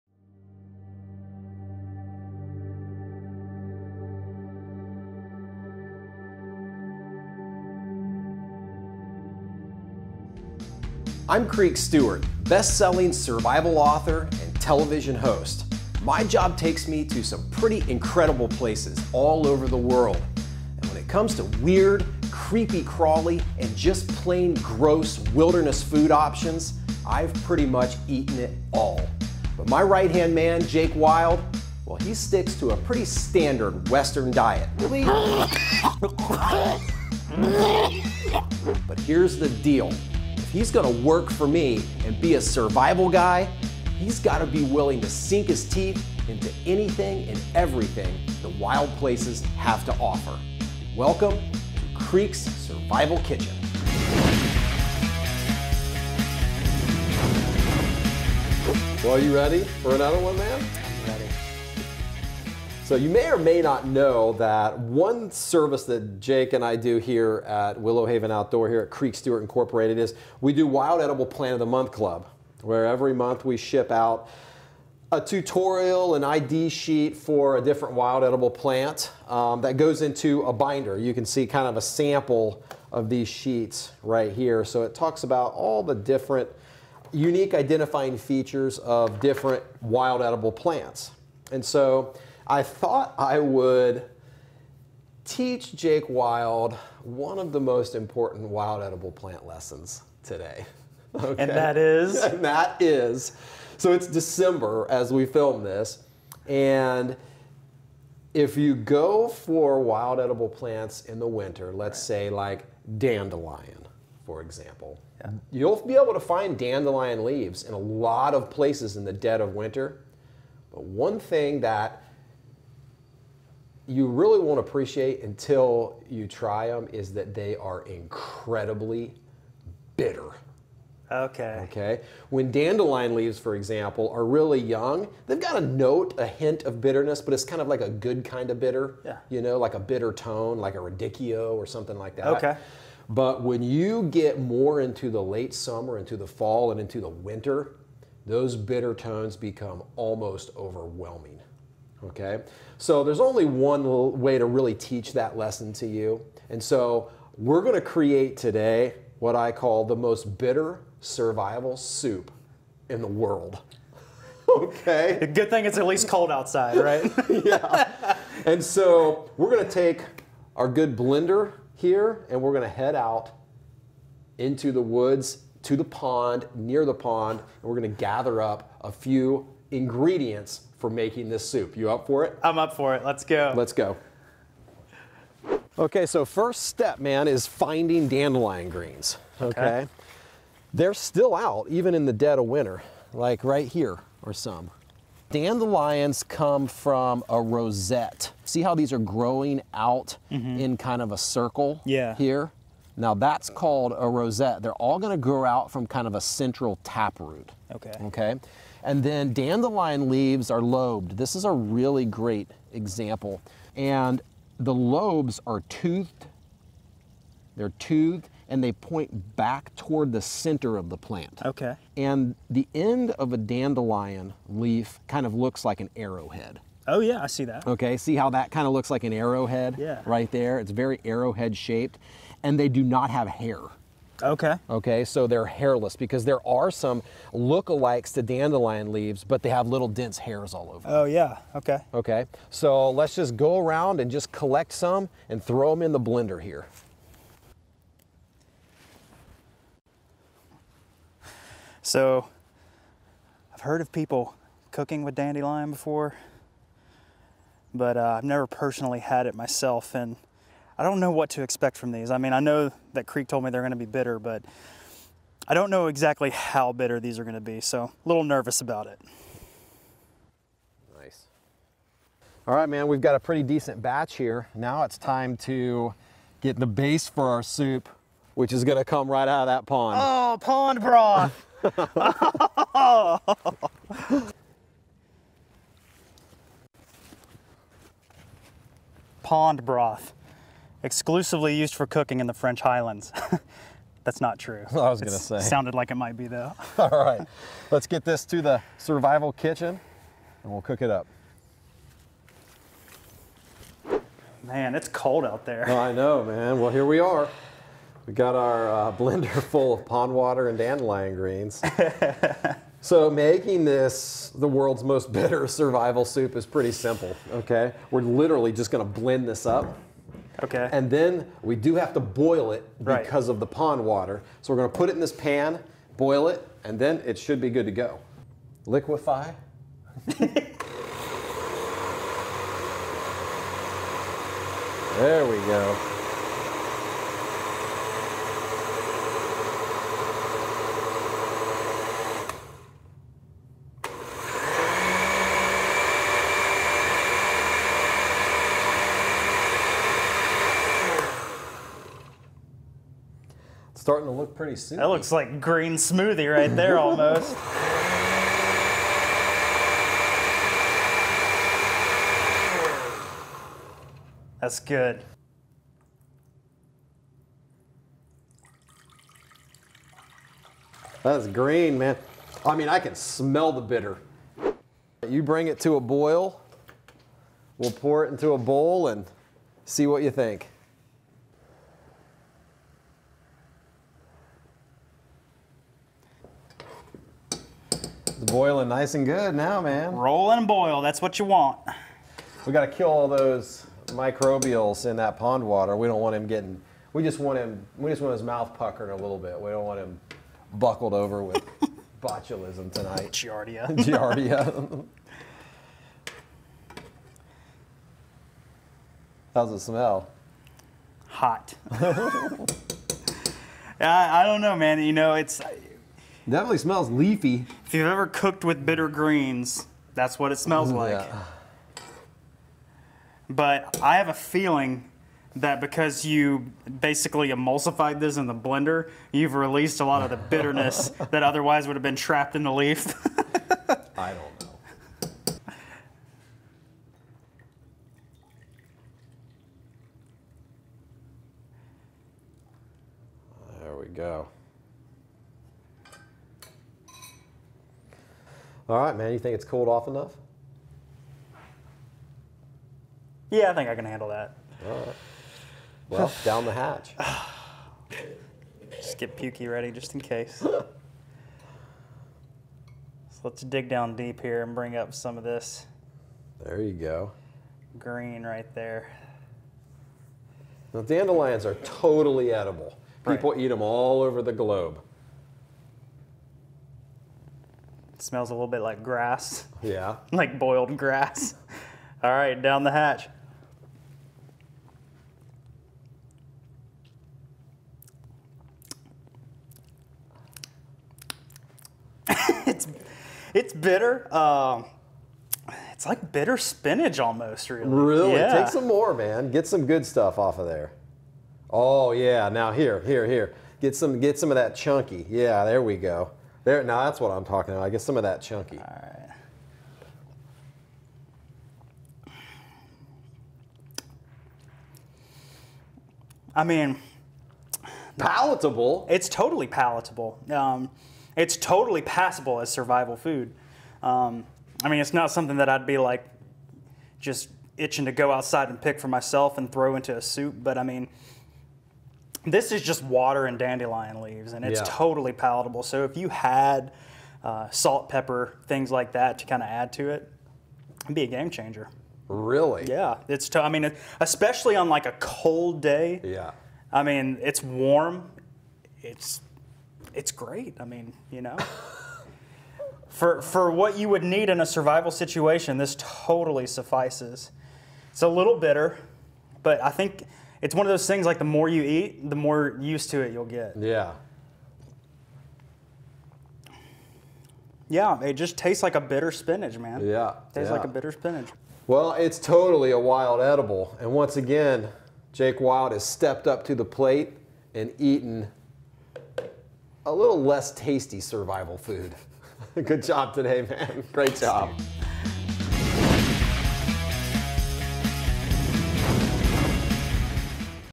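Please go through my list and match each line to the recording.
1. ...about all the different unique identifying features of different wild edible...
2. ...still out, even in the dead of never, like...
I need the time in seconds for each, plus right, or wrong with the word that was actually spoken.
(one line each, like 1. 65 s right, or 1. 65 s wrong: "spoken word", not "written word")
1. 85 s right
2. 190 s wrong: "winter", not "never".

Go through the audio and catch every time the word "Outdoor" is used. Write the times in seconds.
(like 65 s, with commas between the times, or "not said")
68 s.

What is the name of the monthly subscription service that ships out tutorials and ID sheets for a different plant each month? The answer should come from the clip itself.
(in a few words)
Wild Edible Plant of the Month Club.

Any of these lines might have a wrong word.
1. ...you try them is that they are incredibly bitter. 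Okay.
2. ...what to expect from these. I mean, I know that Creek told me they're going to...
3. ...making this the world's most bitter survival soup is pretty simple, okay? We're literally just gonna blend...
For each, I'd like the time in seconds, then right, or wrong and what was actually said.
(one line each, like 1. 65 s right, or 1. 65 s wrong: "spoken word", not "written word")
1. 126 s right
2. 261 s right
3. 313 s right.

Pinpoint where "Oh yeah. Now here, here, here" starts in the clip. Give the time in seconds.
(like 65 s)
501 s.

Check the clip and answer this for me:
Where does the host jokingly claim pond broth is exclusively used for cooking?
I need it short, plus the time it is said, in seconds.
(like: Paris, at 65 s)
The French Highlands, at 292 s.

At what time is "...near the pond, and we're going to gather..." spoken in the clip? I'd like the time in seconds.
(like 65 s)
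176 s.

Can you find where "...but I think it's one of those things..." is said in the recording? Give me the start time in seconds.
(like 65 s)
559 s.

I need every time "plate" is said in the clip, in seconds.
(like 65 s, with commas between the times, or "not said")
576 s.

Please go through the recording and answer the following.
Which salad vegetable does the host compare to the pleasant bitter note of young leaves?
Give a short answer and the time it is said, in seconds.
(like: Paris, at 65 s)
Radicchio, at 140 s.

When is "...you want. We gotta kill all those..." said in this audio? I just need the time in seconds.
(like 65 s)
391 s.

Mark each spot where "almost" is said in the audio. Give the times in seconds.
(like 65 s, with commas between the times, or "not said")
149 s, 356 s, 496 s.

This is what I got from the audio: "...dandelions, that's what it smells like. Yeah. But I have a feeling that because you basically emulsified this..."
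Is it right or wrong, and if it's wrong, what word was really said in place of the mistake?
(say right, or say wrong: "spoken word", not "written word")
wrong: "greens", not "dandelions".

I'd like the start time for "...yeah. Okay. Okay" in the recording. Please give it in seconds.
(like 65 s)
241 s.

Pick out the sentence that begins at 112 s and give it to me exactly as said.
say like dandelion, for example, yeah.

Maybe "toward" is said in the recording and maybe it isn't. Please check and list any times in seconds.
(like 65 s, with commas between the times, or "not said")
219 s.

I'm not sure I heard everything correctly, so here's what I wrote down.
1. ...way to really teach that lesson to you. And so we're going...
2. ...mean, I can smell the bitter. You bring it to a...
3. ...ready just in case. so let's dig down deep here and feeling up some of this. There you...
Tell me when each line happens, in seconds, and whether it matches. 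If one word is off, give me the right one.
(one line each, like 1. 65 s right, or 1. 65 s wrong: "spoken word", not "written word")
1. 154 s right
2. 372 s right
3. 459 s wrong: "bring", not "feeling".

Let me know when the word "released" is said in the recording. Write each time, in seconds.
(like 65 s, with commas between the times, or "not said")
429 s.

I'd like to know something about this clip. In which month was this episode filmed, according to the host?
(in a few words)
December.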